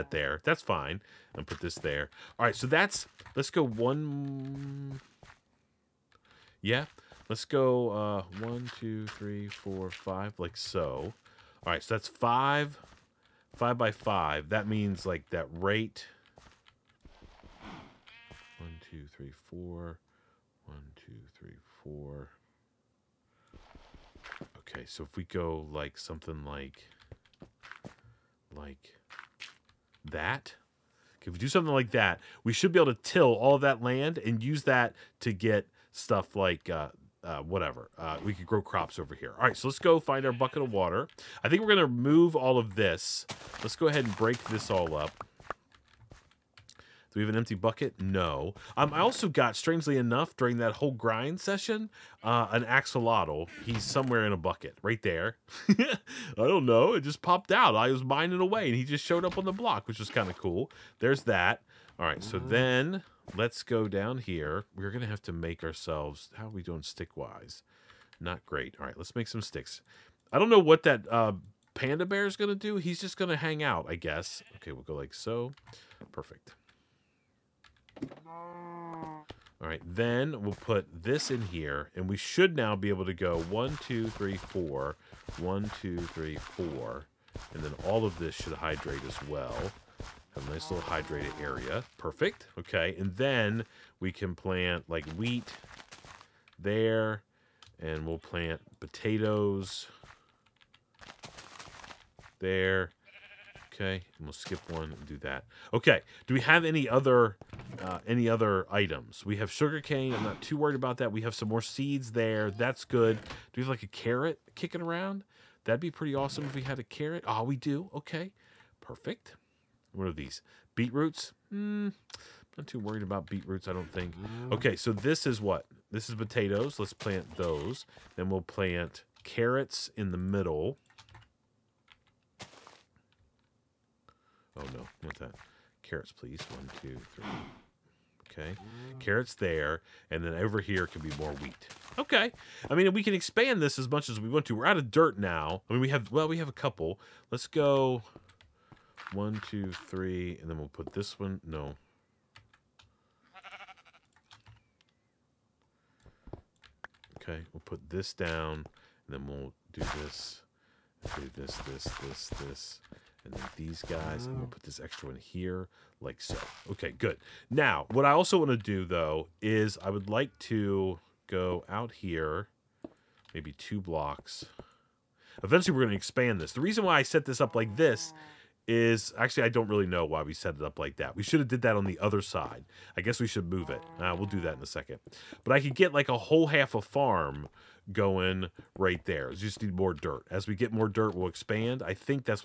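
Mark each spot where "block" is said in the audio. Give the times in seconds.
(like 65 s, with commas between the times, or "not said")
59 s, 173 s.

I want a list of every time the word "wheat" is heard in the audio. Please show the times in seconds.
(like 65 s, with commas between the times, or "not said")
95 s, 141 s.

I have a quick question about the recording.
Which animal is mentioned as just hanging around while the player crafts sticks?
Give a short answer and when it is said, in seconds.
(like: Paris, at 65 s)
panda bear, at 71 s.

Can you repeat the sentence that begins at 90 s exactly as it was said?
Have a nice little hydrated area.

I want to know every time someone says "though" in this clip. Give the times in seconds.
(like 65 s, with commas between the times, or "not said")
168 s.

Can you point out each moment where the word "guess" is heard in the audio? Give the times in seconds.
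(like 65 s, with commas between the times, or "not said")
73 s, 183 s.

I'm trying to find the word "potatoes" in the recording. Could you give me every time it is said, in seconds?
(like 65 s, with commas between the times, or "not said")
98 s, 126 s.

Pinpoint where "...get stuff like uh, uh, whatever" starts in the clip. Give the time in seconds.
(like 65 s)
35 s.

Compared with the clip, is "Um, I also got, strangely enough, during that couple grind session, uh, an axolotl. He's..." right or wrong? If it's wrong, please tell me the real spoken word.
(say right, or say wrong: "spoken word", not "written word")
wrong: "whole", not "couple".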